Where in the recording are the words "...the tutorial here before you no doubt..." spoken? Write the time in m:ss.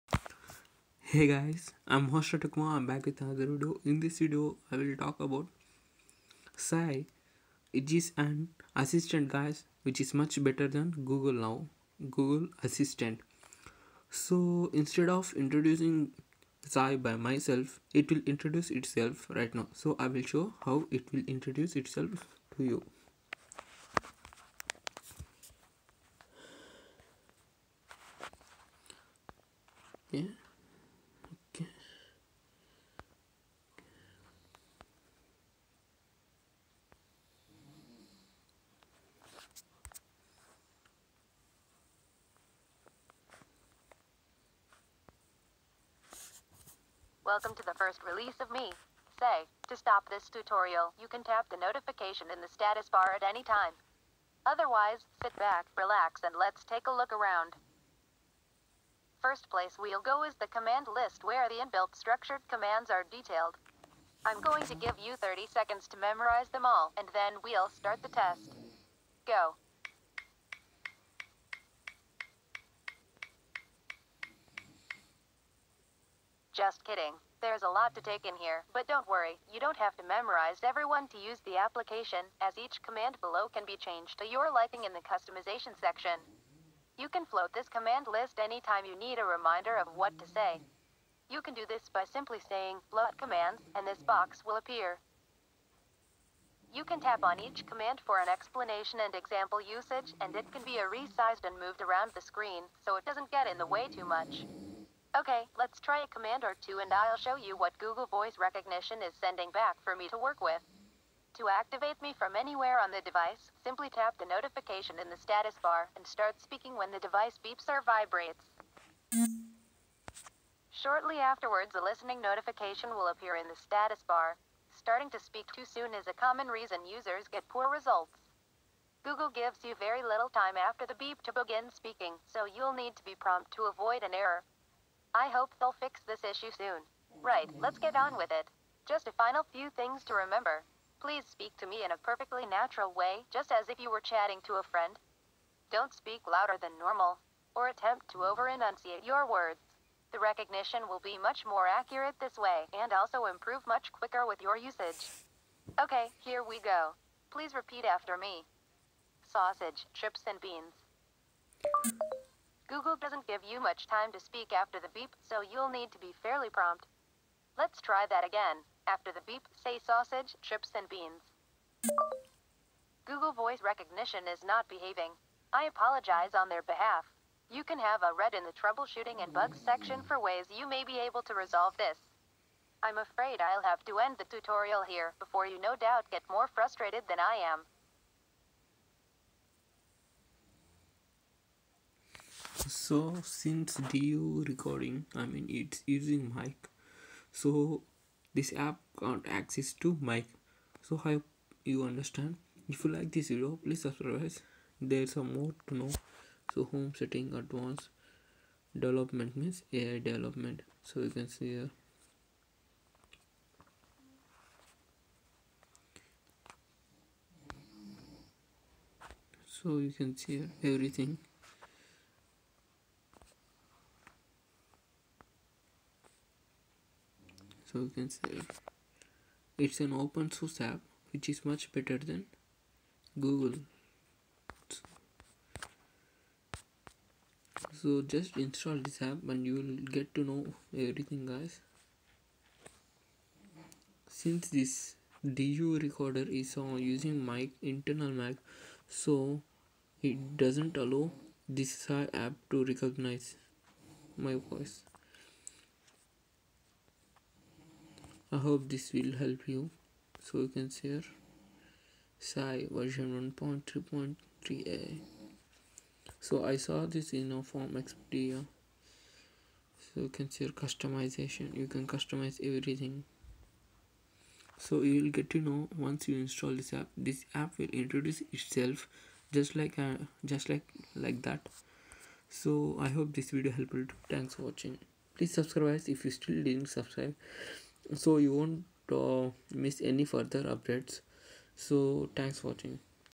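3:04.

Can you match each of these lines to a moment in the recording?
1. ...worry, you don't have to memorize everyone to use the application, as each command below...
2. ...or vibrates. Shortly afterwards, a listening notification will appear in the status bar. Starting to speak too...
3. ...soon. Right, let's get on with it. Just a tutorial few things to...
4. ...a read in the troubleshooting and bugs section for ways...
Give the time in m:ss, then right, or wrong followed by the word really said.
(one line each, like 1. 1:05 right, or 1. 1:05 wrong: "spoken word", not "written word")
1. 1:19 right
2. 1:57 right
3. 2:16 wrong: "final", not "tutorial"
4. 2:58 right.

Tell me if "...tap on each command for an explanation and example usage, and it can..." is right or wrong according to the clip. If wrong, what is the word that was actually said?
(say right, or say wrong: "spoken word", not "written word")
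right.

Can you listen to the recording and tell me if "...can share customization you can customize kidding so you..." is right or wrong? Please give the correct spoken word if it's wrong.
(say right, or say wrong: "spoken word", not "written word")
wrong: "everything", not "kidding".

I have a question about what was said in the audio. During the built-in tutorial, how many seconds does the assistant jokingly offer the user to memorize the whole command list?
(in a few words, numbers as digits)
30.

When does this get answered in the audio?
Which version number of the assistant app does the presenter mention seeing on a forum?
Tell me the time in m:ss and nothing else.
4:23.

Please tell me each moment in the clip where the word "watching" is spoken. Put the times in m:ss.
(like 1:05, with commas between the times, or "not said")
4:44, 4:52.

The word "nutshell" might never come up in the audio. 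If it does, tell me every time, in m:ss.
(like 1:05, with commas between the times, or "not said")
not said.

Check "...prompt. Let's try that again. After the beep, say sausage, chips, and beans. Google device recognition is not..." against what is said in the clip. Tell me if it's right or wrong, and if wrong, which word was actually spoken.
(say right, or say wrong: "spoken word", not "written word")
wrong: "voice", not "device".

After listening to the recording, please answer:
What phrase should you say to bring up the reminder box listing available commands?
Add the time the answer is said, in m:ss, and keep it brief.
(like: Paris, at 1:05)
float commands, at 1:32.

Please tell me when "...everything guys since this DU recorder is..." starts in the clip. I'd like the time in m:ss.
4:00.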